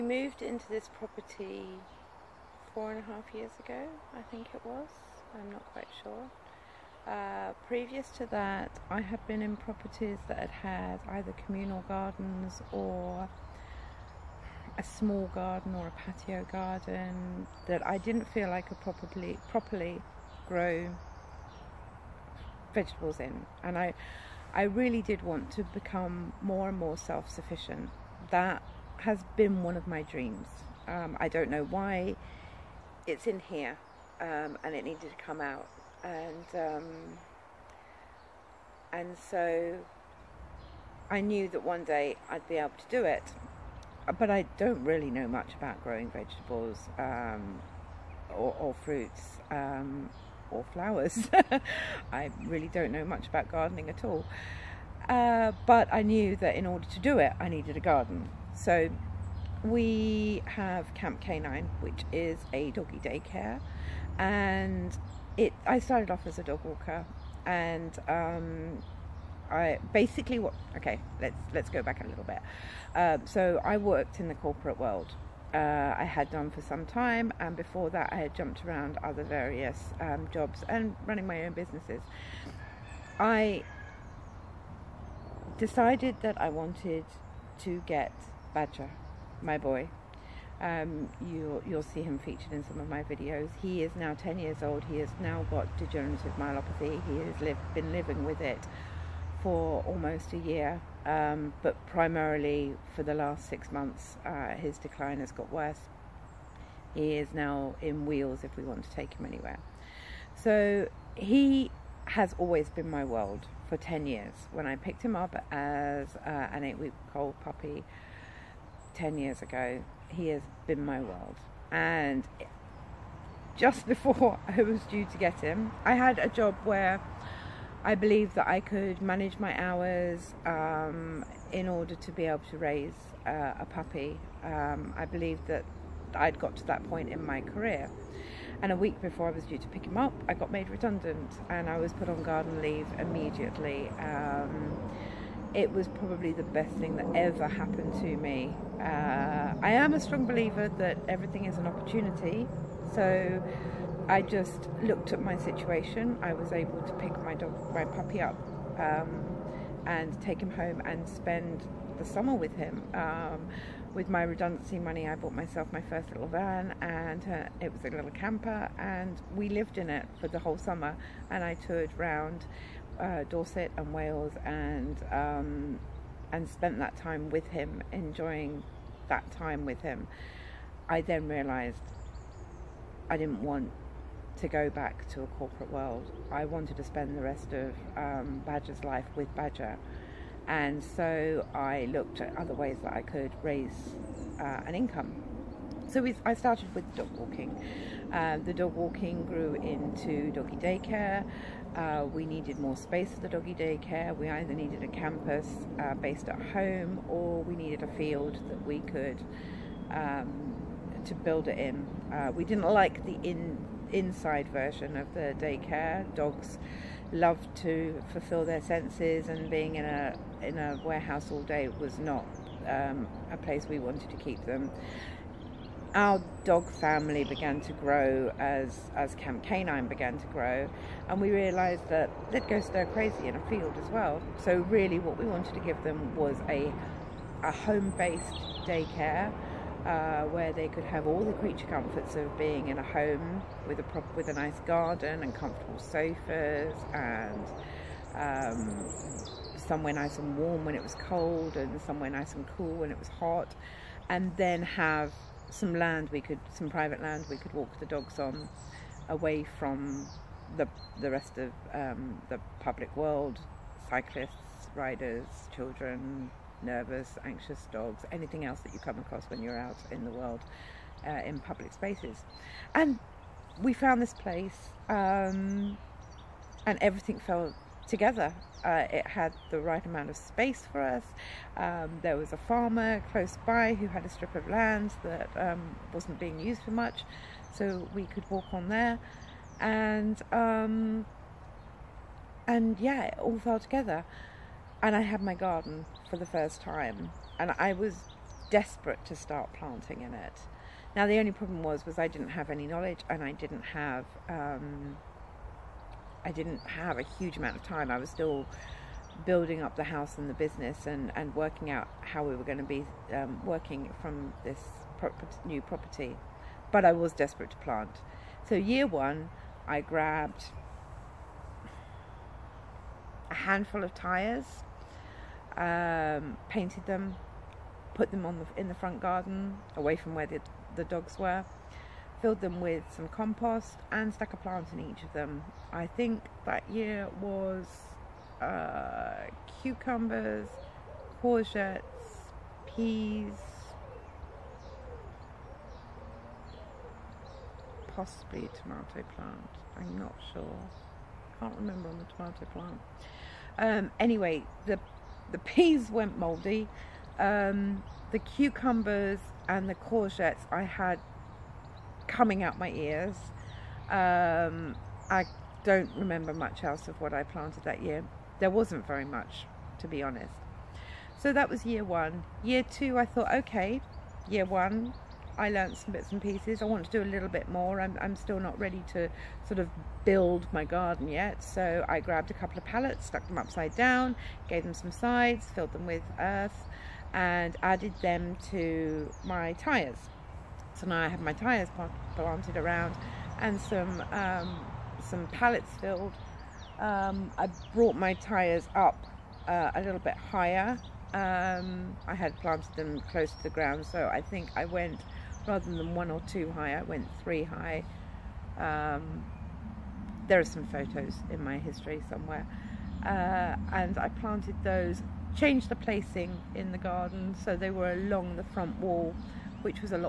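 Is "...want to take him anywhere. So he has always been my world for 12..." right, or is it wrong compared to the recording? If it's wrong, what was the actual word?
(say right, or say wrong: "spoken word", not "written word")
wrong: "10", not "12".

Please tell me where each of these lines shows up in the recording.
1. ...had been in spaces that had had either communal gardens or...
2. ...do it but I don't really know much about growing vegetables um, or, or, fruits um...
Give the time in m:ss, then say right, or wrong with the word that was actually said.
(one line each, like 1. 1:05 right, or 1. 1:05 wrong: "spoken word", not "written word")
1. 0:08 wrong: "properties", not "spaces"
2. 0:42 right.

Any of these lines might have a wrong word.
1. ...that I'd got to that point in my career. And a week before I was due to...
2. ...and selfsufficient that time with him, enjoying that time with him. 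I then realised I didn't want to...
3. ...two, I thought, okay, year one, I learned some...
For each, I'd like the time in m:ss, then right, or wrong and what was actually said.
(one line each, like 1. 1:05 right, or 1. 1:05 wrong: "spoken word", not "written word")
1. 2:15 right
2. 2:56 wrong: "spent", not "selfsufficient"
3. 6:12 right.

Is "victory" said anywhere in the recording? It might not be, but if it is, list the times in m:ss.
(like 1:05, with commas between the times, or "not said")
not said.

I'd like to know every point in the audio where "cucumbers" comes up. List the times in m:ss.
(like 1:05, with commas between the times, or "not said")
5:39, 5:58.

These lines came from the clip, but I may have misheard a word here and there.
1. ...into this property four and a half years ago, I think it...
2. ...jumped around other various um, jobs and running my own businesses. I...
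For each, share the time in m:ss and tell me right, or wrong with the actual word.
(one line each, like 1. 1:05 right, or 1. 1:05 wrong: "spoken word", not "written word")
1. 0:00 right
2. 1:18 right.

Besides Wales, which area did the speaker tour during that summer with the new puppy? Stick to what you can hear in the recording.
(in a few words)
Dorset.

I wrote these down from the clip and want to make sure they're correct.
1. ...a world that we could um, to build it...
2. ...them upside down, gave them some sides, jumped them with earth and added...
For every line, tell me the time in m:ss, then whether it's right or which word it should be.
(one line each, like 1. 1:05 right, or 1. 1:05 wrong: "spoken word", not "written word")
1. 3:27 wrong: "field", not "world"
2. 6:23 wrong: "filled", not "jumped".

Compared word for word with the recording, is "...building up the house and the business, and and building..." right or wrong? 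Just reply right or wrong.
wrong.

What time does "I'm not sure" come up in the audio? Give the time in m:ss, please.
5:49.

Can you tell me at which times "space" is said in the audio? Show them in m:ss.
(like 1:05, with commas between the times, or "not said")
3:22, 4:31, 4:40.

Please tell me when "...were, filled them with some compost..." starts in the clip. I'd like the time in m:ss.
5:31.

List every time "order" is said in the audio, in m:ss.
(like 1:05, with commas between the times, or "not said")
0:56, 2:11.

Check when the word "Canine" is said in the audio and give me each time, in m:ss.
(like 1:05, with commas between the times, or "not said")
1:01, 3:49.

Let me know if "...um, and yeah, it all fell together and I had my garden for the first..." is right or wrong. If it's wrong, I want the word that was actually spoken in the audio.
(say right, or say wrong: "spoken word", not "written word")
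right.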